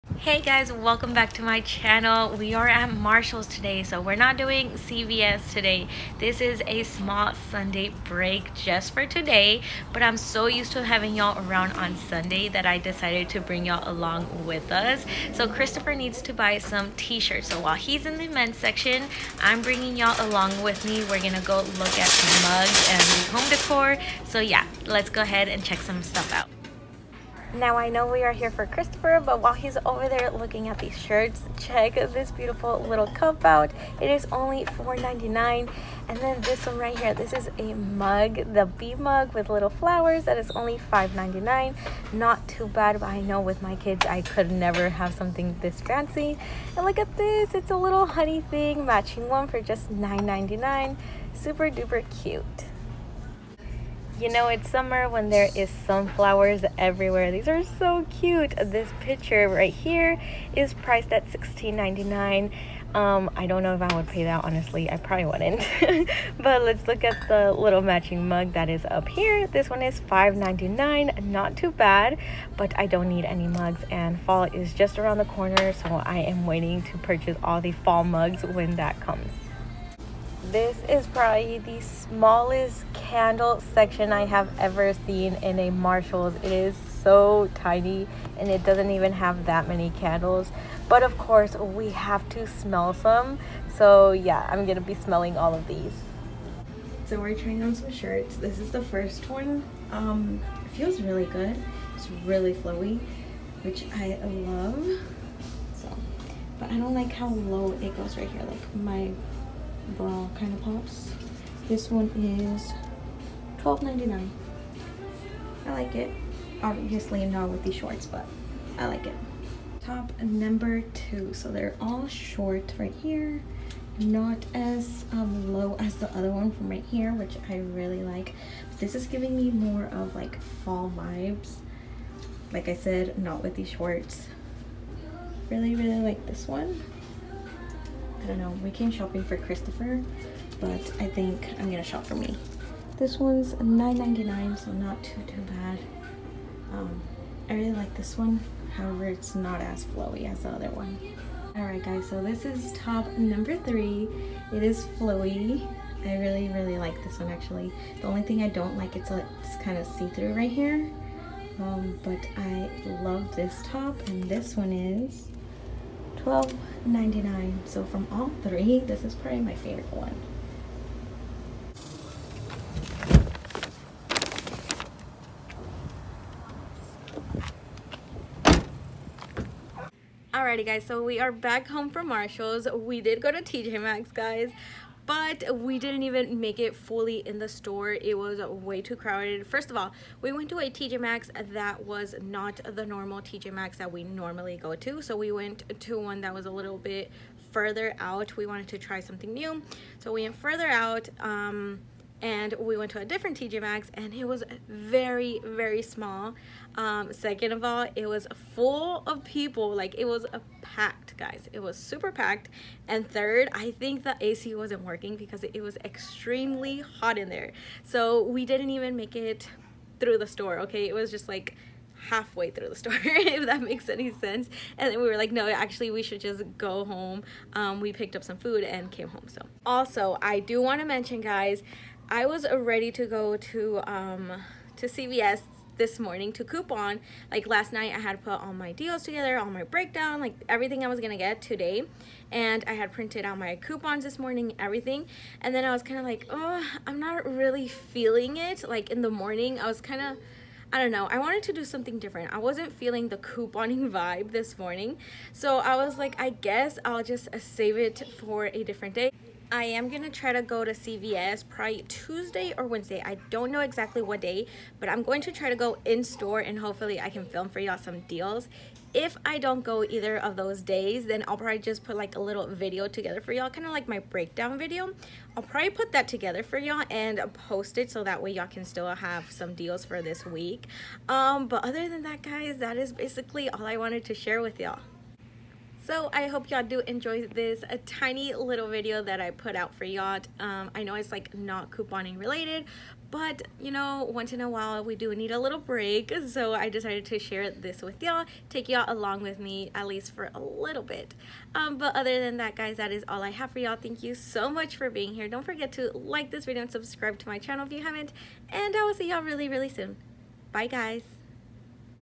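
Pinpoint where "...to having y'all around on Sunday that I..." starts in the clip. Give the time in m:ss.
0:10.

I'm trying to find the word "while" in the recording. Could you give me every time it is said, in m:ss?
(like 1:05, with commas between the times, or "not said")
0:17, 0:29, 4:54.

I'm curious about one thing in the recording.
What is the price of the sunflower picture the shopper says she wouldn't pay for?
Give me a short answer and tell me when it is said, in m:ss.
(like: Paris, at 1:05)
$16.99, at 1:01.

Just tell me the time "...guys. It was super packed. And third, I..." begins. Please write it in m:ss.
3:31.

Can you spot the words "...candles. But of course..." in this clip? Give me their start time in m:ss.
1:29.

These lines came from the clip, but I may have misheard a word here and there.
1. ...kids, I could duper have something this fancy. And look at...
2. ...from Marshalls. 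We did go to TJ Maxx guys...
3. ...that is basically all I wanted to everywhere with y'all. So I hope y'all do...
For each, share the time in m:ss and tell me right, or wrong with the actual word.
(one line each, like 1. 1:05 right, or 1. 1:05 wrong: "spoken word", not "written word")
1. 0:43 wrong: "never", not "duper"
2. 3:01 right
3. 4:42 wrong: "share", not "everywhere".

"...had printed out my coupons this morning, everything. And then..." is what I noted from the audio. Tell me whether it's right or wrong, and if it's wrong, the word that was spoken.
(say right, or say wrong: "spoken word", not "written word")
right.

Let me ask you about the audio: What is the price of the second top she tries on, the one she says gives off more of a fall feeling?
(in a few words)
$9.99.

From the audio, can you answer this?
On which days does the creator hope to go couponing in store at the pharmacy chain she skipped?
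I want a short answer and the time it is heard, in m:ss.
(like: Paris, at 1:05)
Tuesday or Wednesday, at 4:21.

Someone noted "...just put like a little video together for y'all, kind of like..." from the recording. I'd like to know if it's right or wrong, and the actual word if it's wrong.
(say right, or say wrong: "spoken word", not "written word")
right.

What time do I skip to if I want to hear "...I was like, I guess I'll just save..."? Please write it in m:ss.
4:15.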